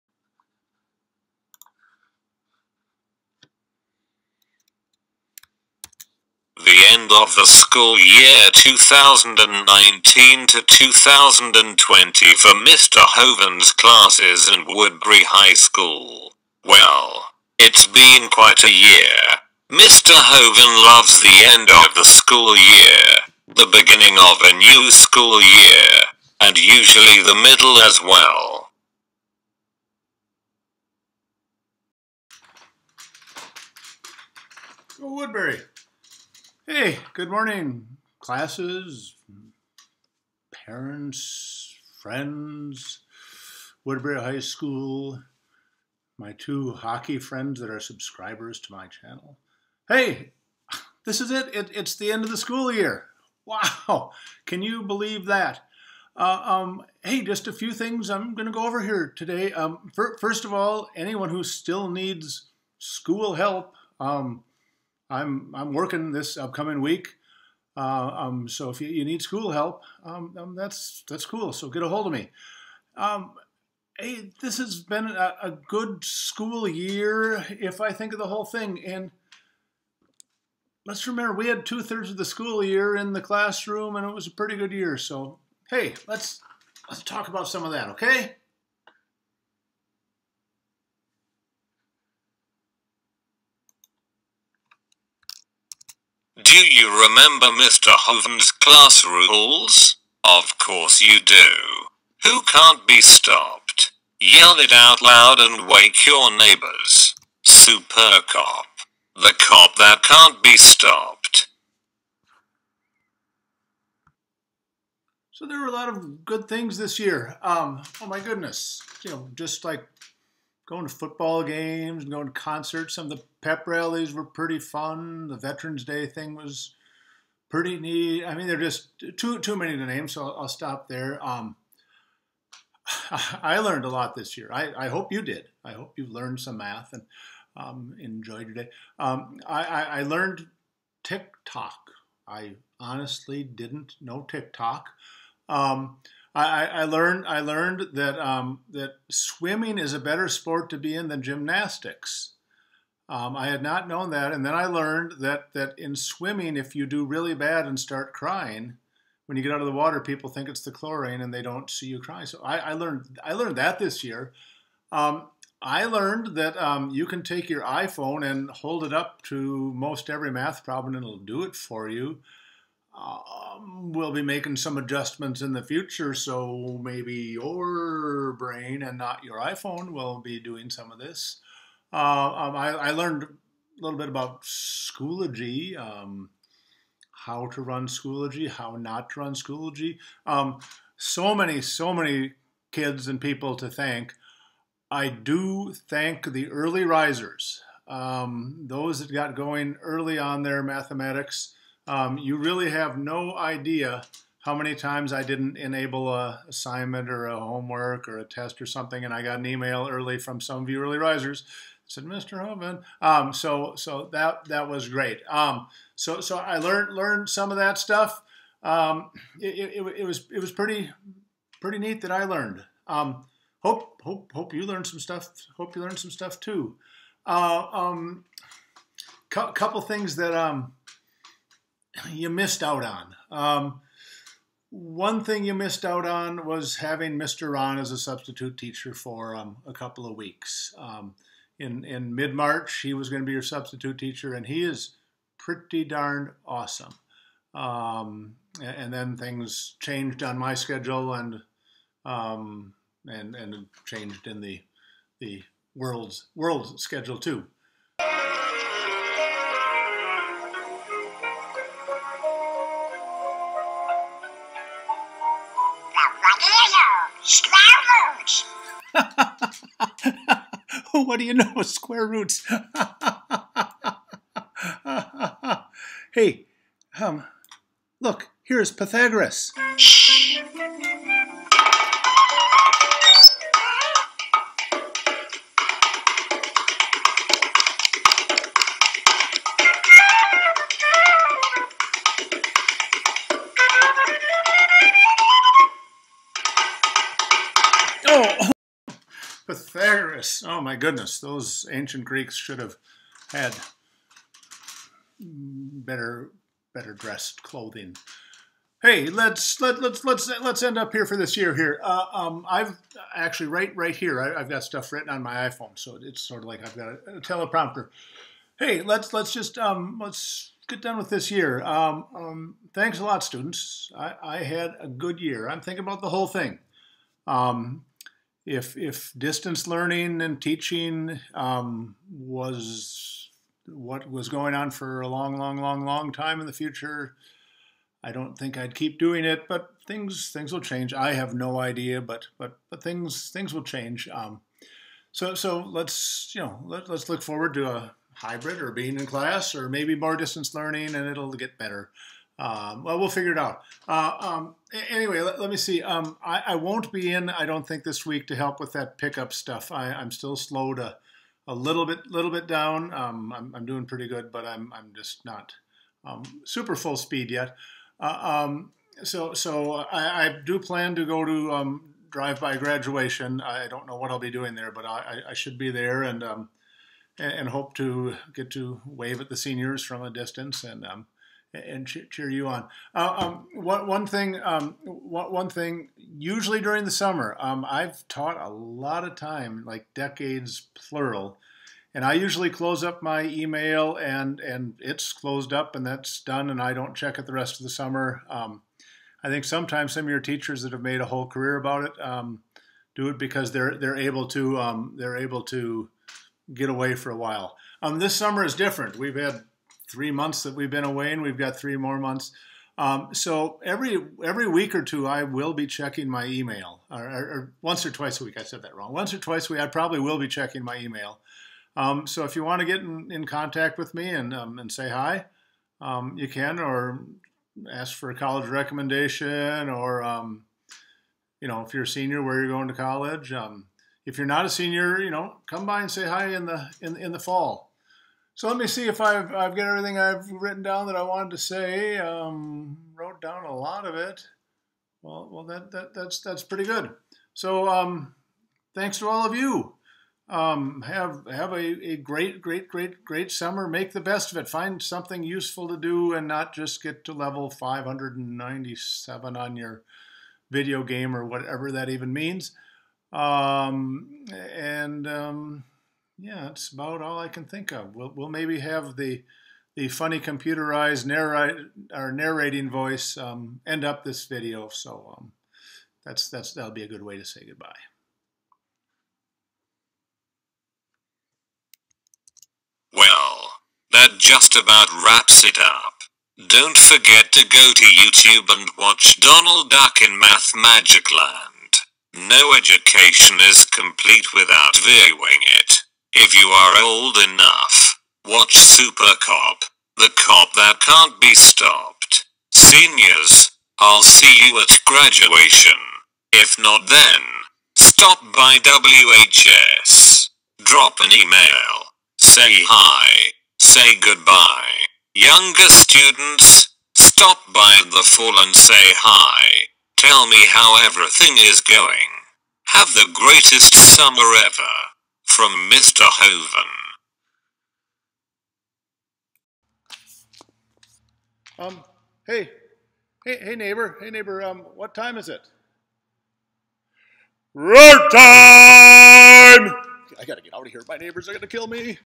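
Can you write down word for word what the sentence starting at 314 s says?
I, have got stuff written on my iPhone, so it's sort of like I've got a, a teleprompter.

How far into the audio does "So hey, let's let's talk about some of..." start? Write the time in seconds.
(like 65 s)
84 s.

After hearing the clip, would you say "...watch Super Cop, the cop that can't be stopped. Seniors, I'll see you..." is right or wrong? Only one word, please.
right.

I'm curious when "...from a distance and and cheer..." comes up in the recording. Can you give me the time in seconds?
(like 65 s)
379 s.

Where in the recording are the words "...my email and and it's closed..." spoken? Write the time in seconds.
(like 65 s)
393 s.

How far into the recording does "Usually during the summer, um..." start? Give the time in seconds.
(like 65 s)
385 s.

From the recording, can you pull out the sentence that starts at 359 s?
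I, am still slow to a little bit, little bit down.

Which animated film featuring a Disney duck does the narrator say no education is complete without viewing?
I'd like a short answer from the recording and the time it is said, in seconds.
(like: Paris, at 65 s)
Donald Duck in Mathmagic Land, at 489 s.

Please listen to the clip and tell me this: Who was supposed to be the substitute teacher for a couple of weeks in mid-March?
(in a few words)
Mr. Ron.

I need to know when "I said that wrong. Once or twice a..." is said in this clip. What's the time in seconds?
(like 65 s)
418 s.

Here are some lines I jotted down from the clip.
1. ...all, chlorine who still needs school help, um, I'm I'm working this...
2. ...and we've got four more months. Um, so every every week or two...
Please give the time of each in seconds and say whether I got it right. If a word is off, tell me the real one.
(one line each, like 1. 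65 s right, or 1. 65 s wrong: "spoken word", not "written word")
1. 60 s wrong: "anyone", not "chlorine"
2. 411 s wrong: "three", not "four".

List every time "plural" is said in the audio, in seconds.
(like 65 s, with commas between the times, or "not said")
390 s.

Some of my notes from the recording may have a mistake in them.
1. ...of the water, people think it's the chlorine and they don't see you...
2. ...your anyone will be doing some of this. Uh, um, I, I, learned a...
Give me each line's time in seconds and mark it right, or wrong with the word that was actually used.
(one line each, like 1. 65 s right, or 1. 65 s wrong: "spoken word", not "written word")
1. 159 s right
2. 179 s wrong: "iPhone", not "anyone".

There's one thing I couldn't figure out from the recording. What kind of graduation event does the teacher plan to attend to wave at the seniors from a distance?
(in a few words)
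Drive-by graduation.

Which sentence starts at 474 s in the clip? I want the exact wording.
So um, that's that's that'll be a good way to say goodbye.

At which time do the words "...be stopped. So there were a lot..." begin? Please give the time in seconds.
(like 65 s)
110 s.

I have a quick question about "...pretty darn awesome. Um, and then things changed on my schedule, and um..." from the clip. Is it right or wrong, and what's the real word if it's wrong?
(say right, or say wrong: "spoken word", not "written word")
right.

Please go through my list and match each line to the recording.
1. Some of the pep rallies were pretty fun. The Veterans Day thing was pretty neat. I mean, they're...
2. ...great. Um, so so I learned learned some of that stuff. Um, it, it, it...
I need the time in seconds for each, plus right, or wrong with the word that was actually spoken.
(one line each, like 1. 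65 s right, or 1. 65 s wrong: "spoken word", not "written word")
1. 122 s right
2. 214 s right.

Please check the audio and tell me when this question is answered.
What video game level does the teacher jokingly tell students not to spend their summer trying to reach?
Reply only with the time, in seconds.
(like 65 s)
457 s.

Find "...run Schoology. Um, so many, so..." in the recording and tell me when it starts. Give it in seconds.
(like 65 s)
189 s.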